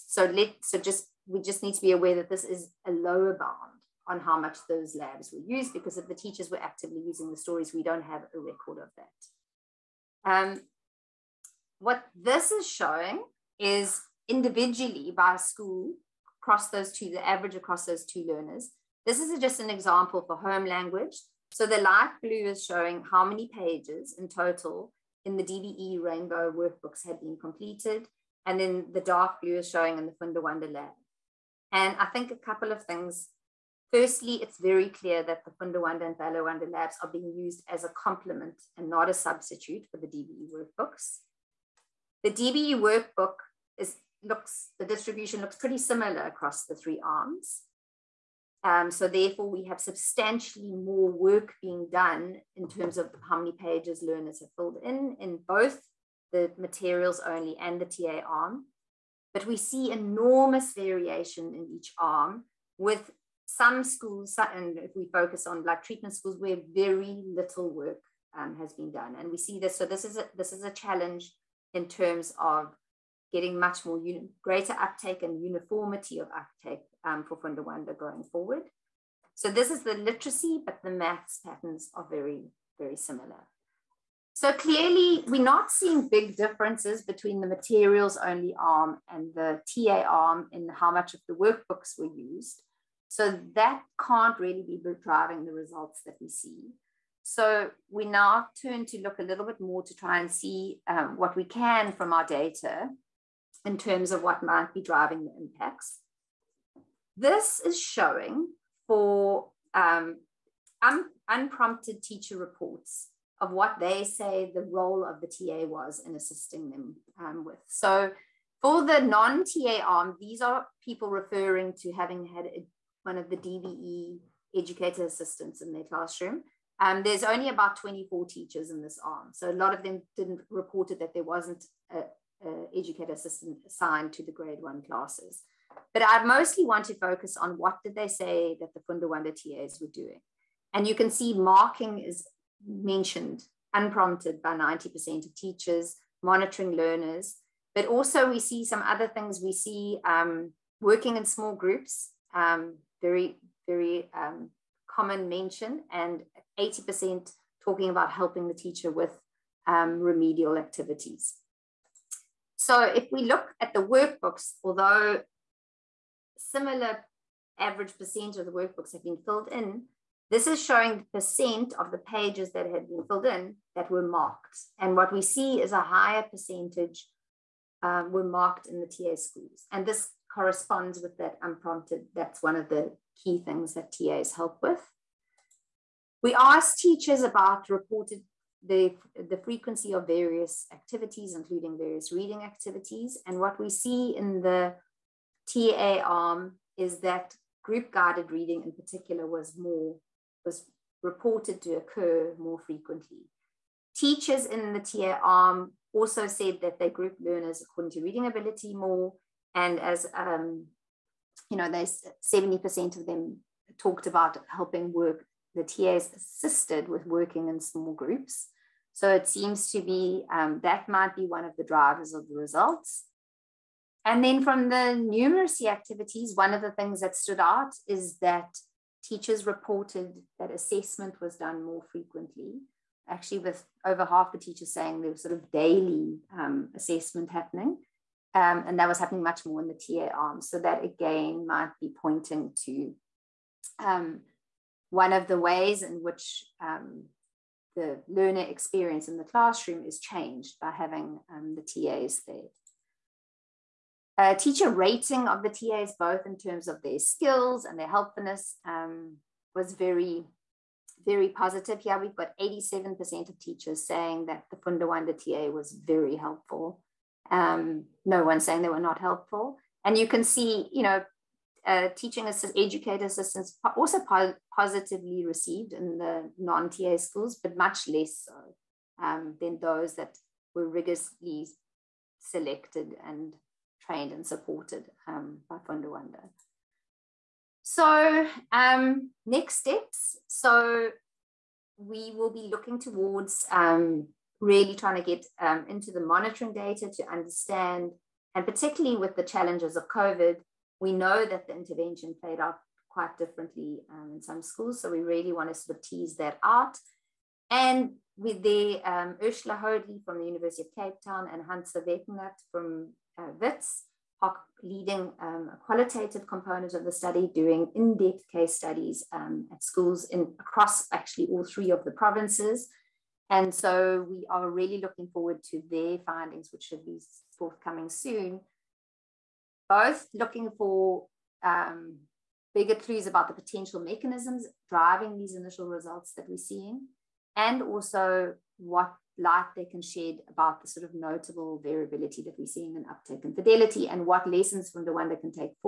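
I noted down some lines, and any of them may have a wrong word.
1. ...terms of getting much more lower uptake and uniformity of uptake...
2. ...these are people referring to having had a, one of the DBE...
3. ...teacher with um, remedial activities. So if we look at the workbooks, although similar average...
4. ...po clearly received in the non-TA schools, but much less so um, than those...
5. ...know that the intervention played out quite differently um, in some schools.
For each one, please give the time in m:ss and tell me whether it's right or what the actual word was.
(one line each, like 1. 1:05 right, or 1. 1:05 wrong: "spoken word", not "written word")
1. 1:11 wrong: "greater", not "lower"
2. 2:00 right
3. 2:38 right
4. 4:33 wrong: "positively", not "clearly"
5. 5:00 right.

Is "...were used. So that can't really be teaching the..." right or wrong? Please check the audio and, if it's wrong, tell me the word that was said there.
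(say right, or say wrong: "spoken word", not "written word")
wrong: "driving", not "teaching".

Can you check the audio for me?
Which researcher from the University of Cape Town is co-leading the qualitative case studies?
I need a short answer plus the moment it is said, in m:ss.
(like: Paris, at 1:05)
Ursula Hoadley, at 5:09.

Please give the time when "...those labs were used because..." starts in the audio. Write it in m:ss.
0:04.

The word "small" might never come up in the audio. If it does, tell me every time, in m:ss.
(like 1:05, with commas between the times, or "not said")
2:31, 3:37.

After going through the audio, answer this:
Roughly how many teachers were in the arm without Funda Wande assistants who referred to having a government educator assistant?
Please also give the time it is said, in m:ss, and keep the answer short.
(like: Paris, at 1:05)
24, at 2:07.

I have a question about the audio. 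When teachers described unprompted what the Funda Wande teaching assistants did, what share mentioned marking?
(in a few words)
90%.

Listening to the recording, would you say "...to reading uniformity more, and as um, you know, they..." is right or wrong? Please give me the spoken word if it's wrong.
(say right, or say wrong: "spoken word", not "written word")
wrong: "ability", not "uniformity".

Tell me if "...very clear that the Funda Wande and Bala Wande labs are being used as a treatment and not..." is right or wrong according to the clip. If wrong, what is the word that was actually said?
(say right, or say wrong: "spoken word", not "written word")
wrong: "complement", not "treatment".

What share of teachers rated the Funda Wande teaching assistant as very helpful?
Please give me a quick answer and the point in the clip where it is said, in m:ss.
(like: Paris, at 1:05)
87%, at 4:22.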